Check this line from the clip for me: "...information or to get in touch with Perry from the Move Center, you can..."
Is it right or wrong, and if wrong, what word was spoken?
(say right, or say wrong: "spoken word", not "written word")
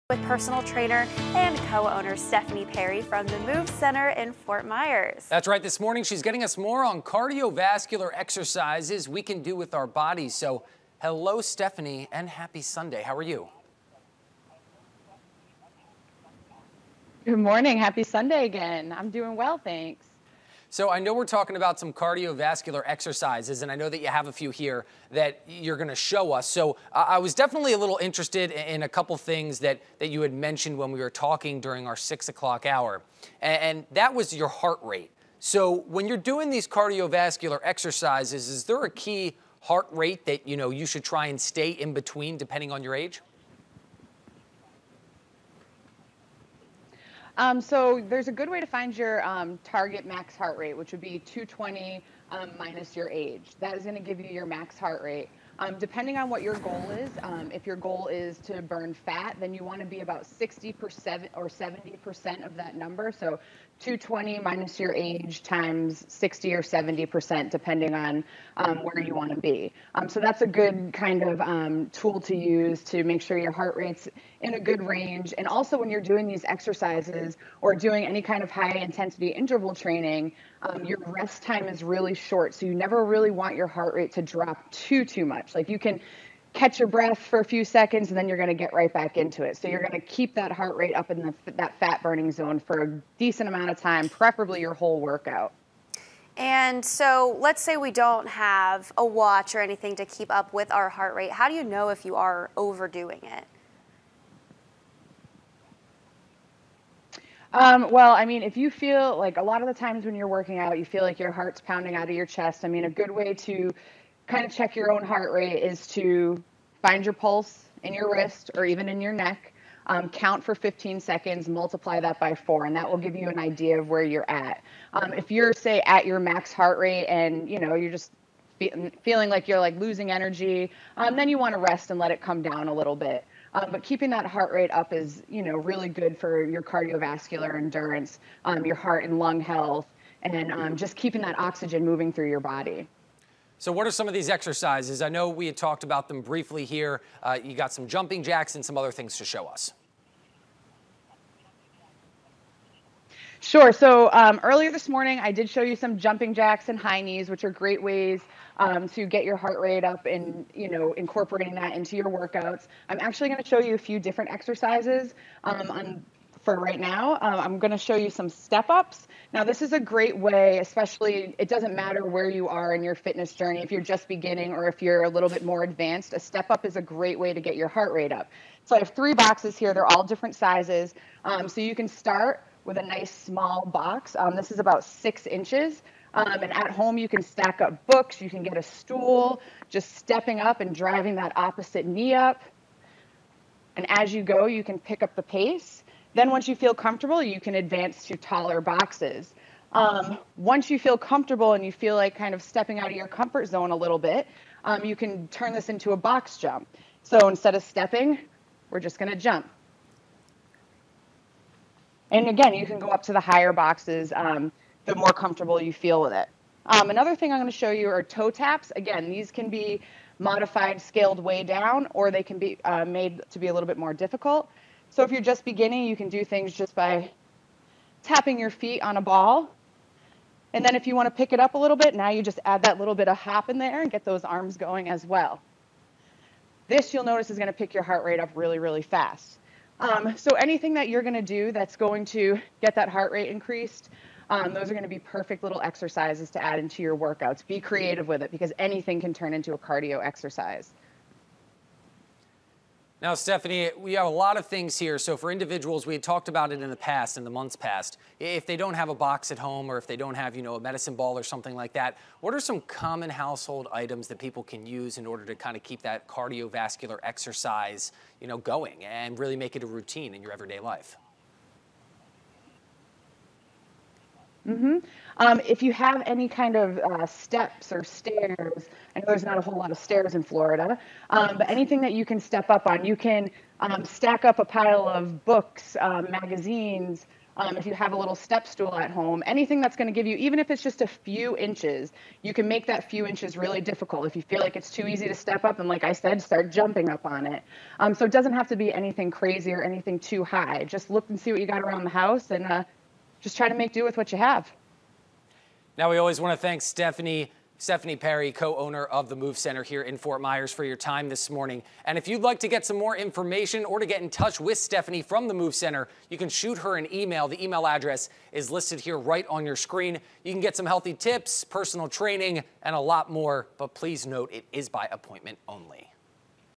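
wrong: "Stephanie", not "Perry".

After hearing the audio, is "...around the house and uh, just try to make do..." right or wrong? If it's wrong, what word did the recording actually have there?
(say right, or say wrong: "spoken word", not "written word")
right.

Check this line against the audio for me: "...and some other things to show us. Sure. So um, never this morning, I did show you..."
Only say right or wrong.
wrong.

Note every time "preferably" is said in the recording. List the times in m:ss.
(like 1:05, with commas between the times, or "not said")
1:34.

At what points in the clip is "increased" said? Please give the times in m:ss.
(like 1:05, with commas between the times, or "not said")
4:03.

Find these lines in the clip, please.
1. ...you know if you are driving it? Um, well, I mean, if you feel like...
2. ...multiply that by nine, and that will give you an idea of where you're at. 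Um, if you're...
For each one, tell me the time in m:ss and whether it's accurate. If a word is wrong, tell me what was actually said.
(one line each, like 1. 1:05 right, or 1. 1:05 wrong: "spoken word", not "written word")
1. 1:41 wrong: "overdoing", not "driving"
2. 2:01 wrong: "four", not "nine".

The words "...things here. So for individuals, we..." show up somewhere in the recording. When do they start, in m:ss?
4:14.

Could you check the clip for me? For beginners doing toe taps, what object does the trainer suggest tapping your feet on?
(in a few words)
A ball.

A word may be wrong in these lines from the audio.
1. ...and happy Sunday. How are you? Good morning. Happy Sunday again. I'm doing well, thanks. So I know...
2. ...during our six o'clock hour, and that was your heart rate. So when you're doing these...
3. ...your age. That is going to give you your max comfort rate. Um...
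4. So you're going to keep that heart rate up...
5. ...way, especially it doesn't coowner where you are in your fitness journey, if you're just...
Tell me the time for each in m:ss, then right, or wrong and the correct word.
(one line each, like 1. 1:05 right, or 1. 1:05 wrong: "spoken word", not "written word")
1. 0:12 right
2. 0:31 right
3. 0:52 wrong: "heart", not "comfort"
4. 1:29 right
5. 2:50 wrong: "matter", not "coowner".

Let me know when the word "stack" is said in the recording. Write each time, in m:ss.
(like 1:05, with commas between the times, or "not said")
3:07, 4:43.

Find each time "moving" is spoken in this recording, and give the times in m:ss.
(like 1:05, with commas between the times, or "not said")
2:21.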